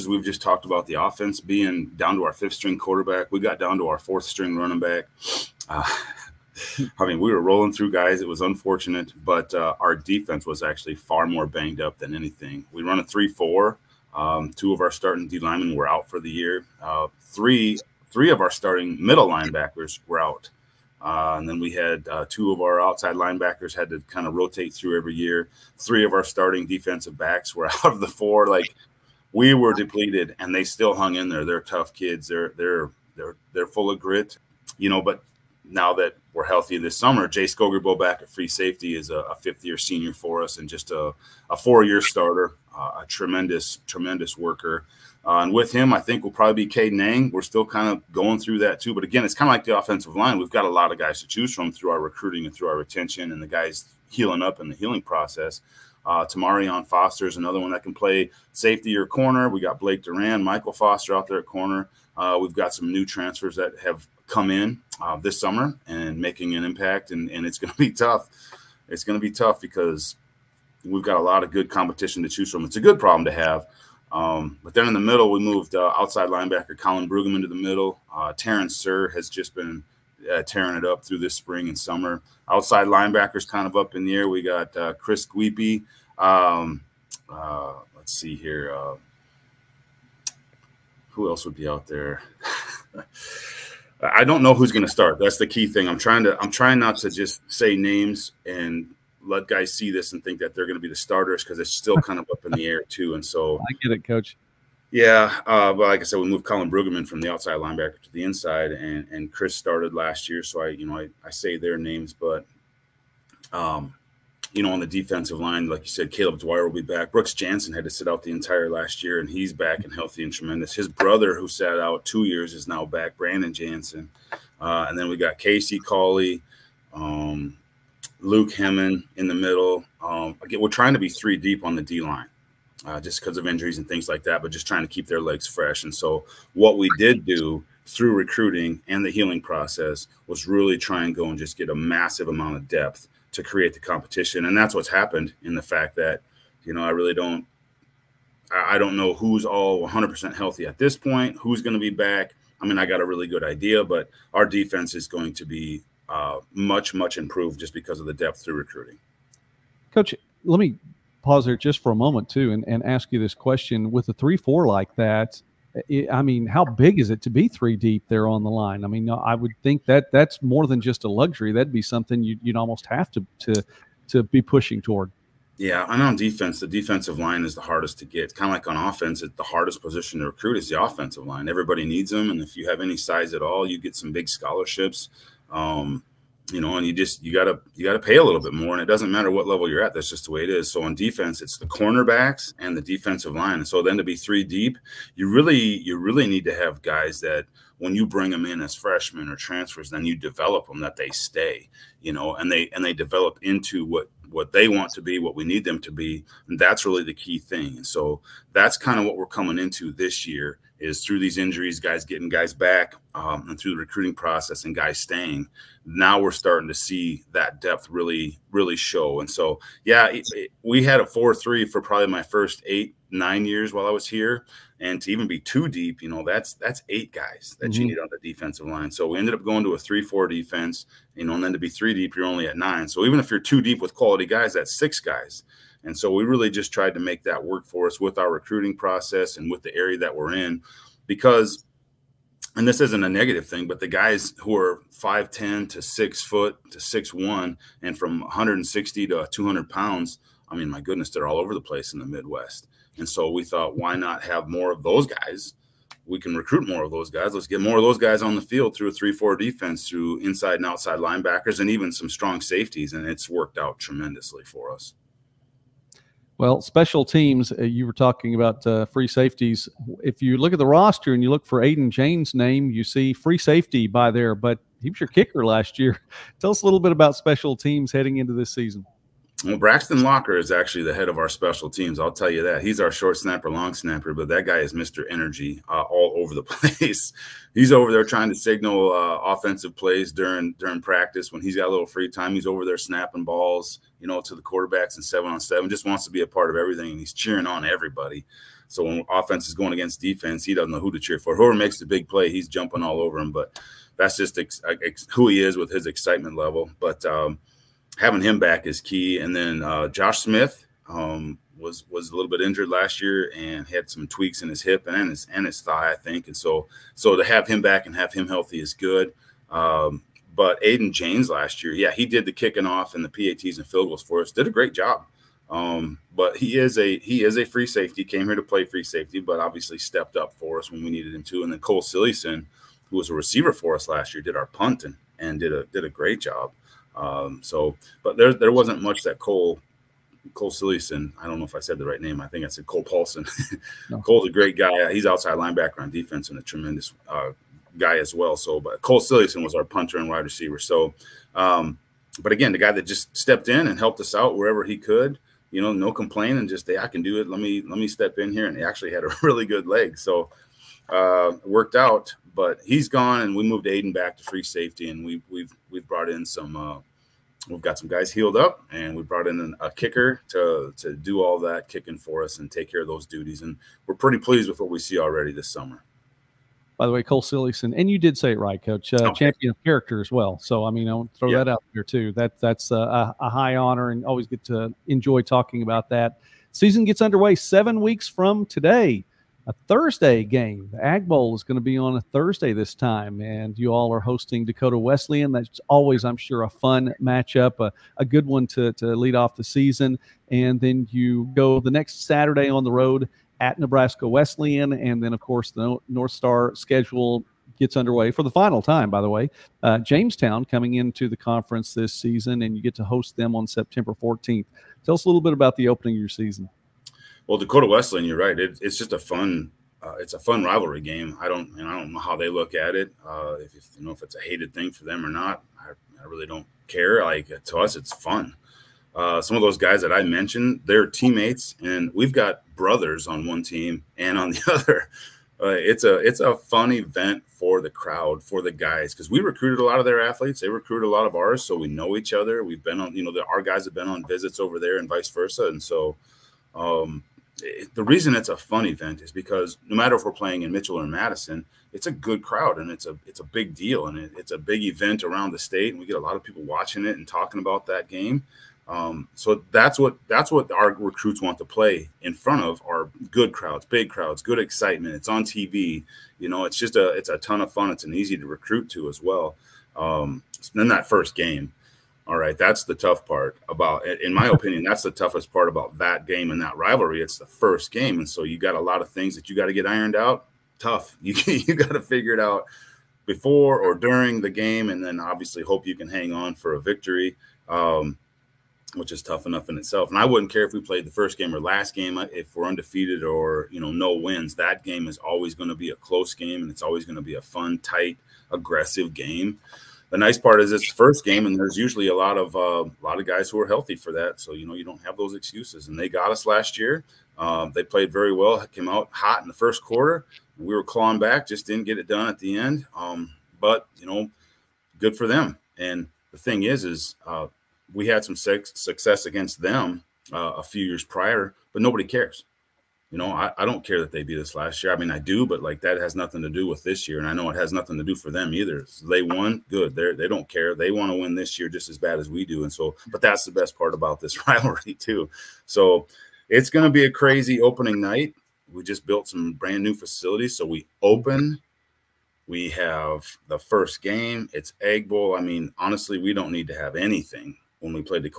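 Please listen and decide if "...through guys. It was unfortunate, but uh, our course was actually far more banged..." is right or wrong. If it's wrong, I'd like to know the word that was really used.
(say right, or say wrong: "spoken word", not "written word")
wrong: "defense", not "course".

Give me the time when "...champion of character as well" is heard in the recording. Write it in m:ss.
6:19.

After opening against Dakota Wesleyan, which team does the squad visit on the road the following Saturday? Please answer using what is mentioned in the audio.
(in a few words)
Nebraska Wesleyan.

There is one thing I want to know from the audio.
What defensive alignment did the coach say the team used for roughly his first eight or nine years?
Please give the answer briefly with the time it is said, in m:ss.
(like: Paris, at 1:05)
four-three, at 3:41.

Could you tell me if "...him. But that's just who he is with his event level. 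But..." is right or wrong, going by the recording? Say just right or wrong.
wrong.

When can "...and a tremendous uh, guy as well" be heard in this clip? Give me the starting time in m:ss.
5:46.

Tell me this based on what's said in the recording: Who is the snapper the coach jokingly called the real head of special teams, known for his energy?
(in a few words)
Braxton Locker.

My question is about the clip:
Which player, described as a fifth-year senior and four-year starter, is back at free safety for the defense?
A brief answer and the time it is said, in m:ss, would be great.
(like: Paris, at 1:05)
Jay Skogerbo, at 0:37.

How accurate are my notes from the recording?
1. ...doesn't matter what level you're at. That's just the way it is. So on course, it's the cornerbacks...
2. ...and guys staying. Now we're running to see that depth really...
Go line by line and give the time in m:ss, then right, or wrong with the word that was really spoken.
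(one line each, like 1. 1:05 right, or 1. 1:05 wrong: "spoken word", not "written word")
1. 3:08 wrong: "defense", not "course"
2. 3:34 wrong: "starting", not "running".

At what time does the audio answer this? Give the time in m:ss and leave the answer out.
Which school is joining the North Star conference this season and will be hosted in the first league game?
6:49.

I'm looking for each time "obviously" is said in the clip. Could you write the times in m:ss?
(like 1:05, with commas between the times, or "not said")
5:29, 8:04.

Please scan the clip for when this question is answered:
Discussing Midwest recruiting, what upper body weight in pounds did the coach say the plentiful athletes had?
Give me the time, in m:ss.
4:09.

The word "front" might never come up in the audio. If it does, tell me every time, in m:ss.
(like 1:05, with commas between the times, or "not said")
7:42.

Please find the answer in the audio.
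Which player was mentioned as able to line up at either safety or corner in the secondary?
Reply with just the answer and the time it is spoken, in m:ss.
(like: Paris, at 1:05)
Tamarion Foster, at 0:56.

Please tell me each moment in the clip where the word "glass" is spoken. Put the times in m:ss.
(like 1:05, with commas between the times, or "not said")
not said.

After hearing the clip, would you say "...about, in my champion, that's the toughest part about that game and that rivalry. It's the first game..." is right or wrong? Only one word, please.
wrong.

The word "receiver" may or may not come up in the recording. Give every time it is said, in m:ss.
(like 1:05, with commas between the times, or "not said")
5:33, 5:50.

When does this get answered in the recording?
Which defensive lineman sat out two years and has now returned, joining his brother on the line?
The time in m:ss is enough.
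2:03.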